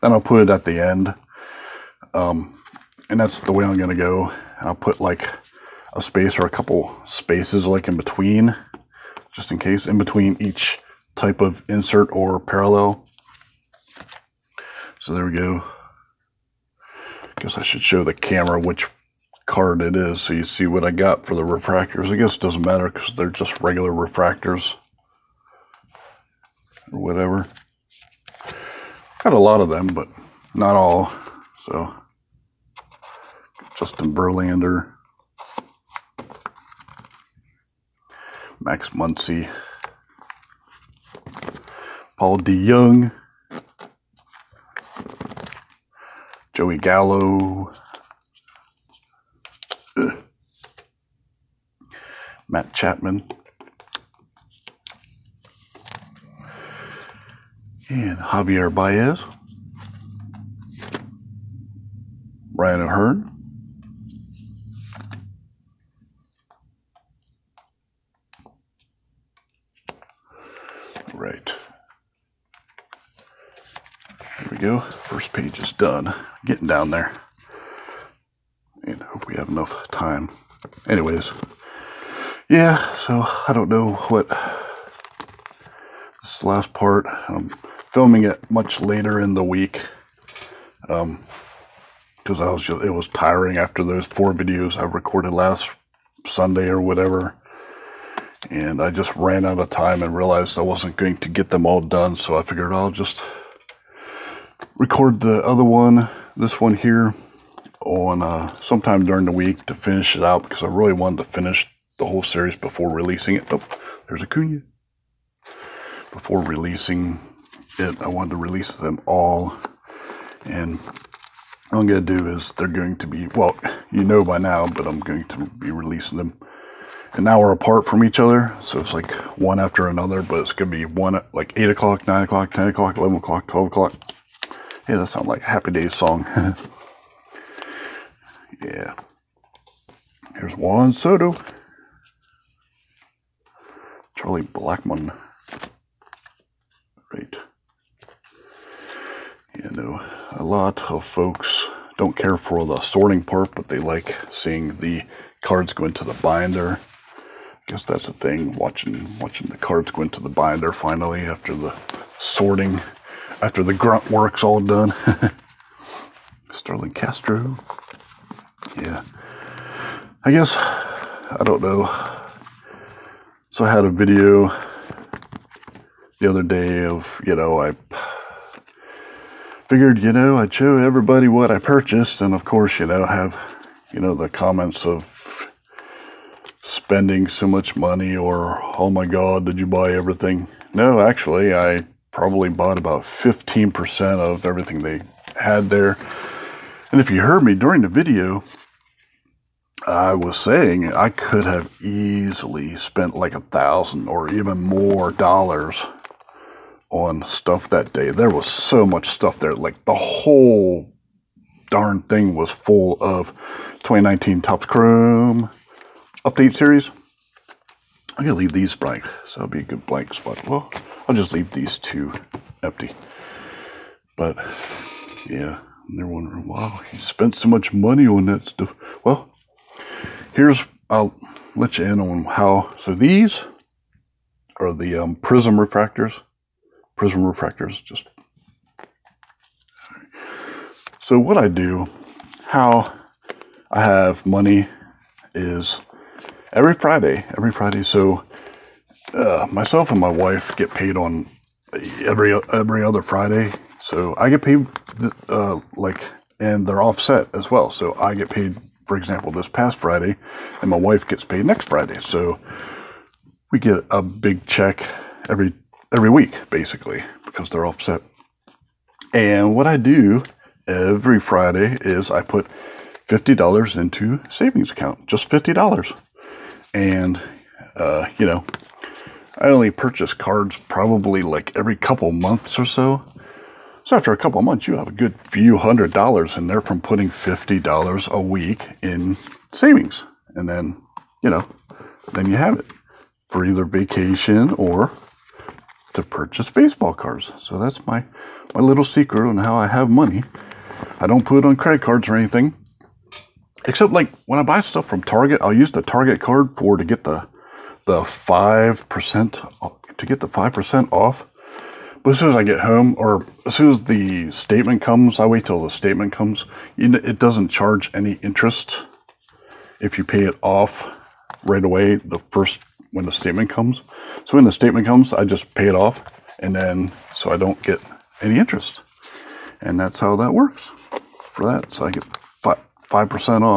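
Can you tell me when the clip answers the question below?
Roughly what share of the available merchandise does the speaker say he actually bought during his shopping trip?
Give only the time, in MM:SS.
03:13.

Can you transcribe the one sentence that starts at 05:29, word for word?
And that's how that works for that.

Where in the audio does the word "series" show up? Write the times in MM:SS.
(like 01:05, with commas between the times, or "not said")
01:52, 03:36.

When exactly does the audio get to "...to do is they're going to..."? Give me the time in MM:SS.
02:02.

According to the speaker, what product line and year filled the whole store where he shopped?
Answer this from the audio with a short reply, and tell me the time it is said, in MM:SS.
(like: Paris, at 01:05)
2019 Topps Chrome, at 03:33.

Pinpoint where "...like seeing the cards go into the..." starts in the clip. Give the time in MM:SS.
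02:33.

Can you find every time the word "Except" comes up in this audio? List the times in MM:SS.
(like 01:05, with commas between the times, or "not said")
05:03.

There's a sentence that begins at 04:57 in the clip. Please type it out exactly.
So that's my my little secret on how I have money.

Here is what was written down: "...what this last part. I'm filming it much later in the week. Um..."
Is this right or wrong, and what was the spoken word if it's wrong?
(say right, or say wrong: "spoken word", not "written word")
right.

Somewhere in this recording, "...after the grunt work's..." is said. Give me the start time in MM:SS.
02:43.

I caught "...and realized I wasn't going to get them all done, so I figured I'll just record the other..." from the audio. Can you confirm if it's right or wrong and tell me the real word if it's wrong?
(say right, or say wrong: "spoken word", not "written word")
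right.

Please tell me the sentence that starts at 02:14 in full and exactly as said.
Hey, that sounds like a Happy Days song.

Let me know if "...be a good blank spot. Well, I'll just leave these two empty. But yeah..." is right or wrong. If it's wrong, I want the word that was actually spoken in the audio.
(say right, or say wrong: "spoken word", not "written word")
right.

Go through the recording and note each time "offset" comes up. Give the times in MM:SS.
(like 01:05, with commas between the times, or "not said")
04:16, 04:27.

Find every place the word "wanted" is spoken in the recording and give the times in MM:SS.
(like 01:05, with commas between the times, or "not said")
01:50, 01:58.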